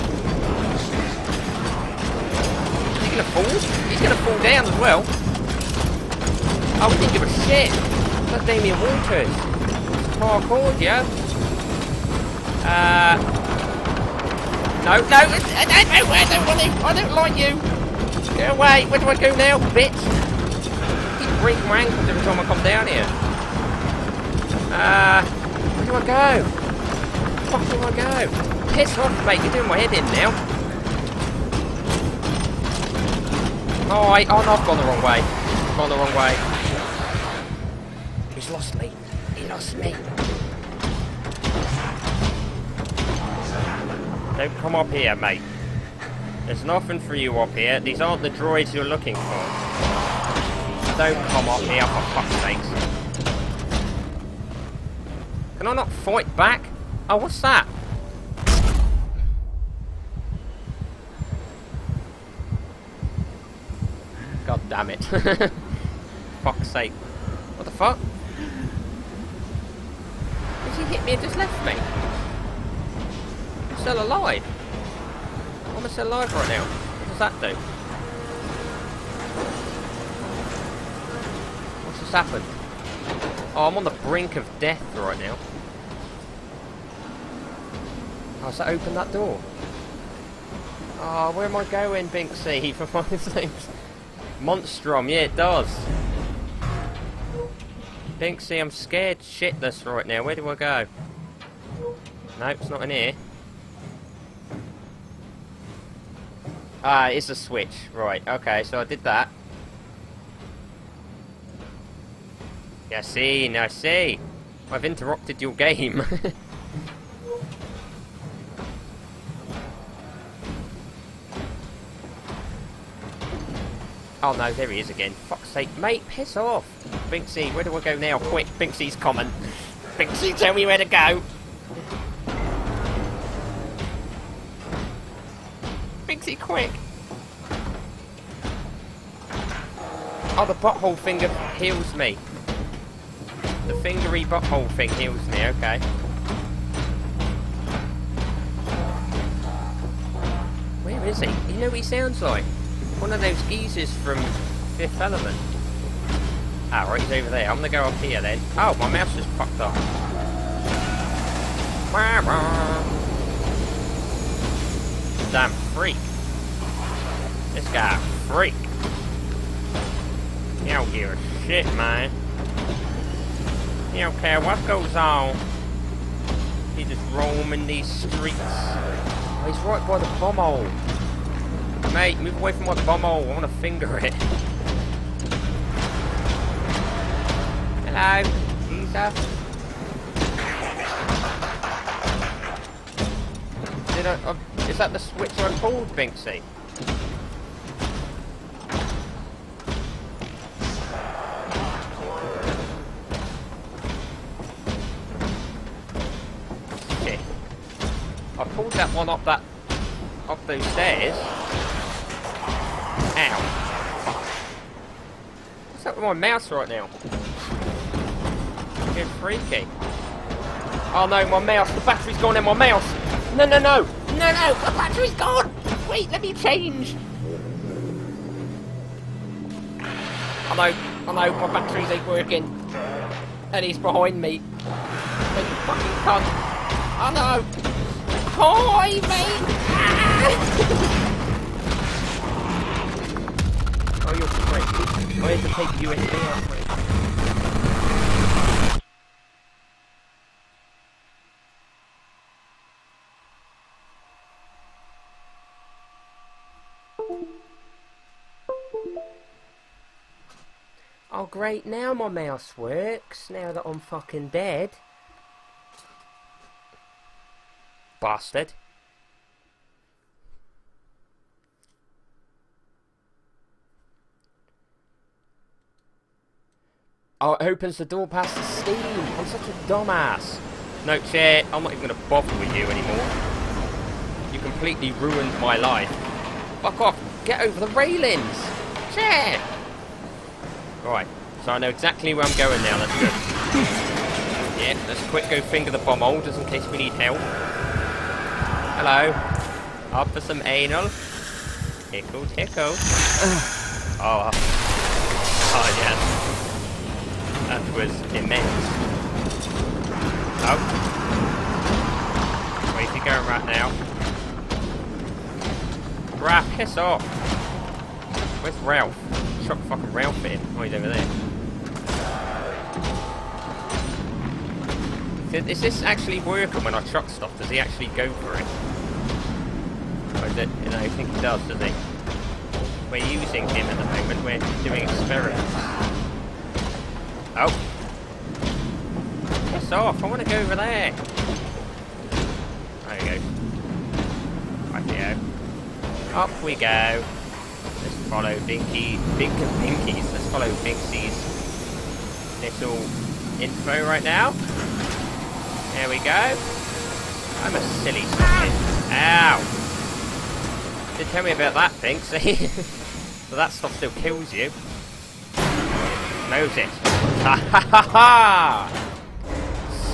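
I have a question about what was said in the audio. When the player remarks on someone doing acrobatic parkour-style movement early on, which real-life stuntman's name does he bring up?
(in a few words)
Damien Walters.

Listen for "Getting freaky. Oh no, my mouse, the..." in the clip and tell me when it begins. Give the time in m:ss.
3:38.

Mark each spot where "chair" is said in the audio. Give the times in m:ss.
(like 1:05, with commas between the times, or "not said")
4:41, 4:48.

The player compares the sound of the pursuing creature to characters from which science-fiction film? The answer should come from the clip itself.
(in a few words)
Fifth Element.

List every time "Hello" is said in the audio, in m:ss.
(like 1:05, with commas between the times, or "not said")
3:07, 4:58.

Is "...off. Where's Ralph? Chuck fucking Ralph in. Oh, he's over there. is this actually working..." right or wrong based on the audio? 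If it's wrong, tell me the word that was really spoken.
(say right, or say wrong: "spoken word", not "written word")
right.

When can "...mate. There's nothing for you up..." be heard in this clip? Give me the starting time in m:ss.
0:45.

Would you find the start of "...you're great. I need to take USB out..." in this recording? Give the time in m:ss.
4:04.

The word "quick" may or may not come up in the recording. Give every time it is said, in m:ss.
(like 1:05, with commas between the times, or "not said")
2:08, 2:16, 4:55.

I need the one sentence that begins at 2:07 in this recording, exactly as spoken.
Binksy, where do I go now?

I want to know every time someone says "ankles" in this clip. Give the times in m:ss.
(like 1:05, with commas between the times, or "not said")
0:21.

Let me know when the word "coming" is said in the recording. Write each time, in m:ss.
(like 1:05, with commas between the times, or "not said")
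2:08.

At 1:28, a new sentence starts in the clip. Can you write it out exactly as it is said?
How's oh, that open that door.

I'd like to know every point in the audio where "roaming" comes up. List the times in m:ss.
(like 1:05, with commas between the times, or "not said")
2:57.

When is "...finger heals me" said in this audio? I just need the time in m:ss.
2:20.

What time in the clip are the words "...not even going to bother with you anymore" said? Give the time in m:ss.
4:41.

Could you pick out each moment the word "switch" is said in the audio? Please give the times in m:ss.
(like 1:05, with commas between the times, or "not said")
1:47, 3:14.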